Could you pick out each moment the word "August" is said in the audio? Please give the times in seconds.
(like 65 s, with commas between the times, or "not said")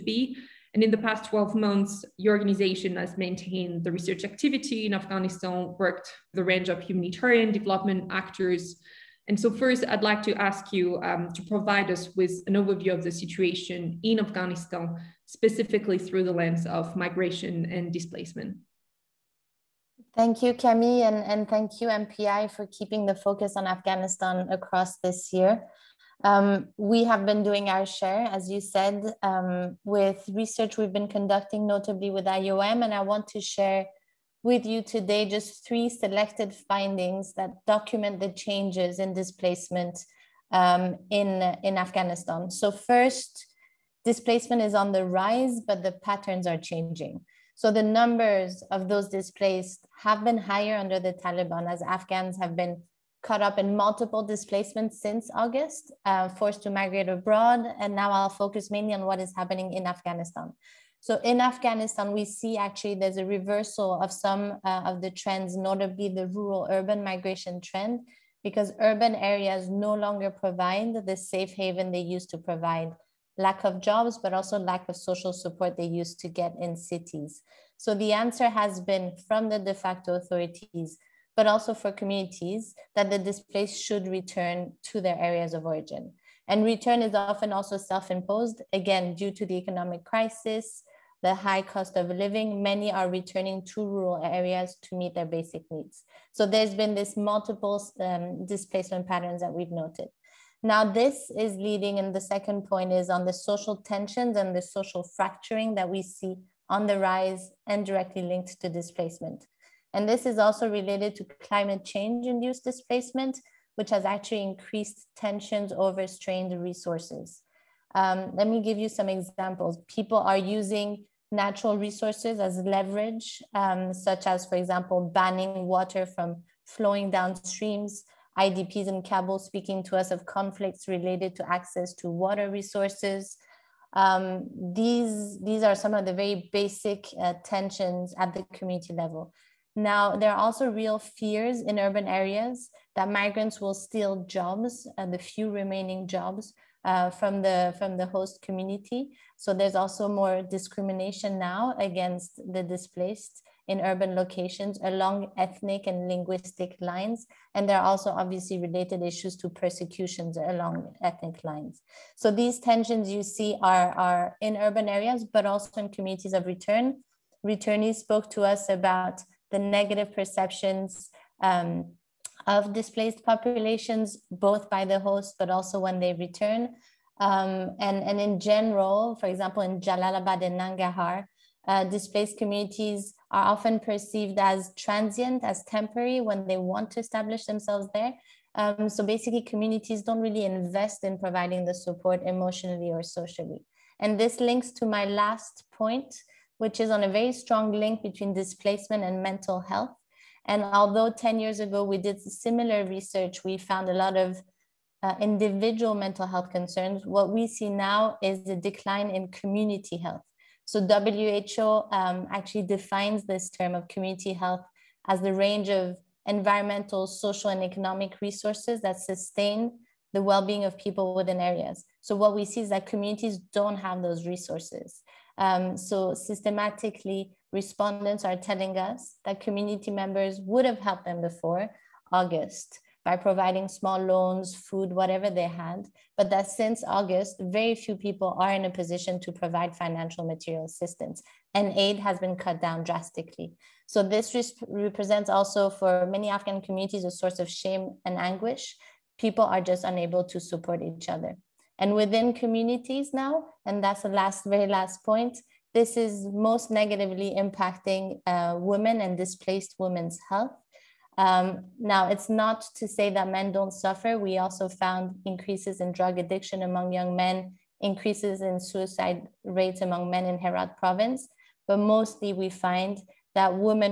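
55 s, 232 s, 236 s.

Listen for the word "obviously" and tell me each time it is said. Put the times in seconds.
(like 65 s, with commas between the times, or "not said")
158 s.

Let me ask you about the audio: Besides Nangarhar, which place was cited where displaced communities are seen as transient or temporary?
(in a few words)
Jalalabad.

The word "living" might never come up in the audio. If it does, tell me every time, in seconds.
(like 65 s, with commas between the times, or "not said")
92 s.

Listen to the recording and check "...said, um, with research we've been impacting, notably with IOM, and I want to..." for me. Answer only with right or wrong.
wrong.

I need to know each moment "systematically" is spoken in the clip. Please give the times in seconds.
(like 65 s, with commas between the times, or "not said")
226 s.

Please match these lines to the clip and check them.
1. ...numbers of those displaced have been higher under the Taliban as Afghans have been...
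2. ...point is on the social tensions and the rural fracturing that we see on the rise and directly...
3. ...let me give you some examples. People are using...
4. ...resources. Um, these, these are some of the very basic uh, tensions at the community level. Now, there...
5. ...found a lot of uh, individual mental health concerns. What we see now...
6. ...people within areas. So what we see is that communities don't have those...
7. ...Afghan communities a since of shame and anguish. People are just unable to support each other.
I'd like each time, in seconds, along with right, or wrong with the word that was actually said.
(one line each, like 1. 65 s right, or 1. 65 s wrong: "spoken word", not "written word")
1. 47 s right
2. 102 s wrong: "social", not "rural"
3. 118 s right
4. 132 s right
5. 203 s right
6. 220 s right
7. 246 s wrong: "source", not "since".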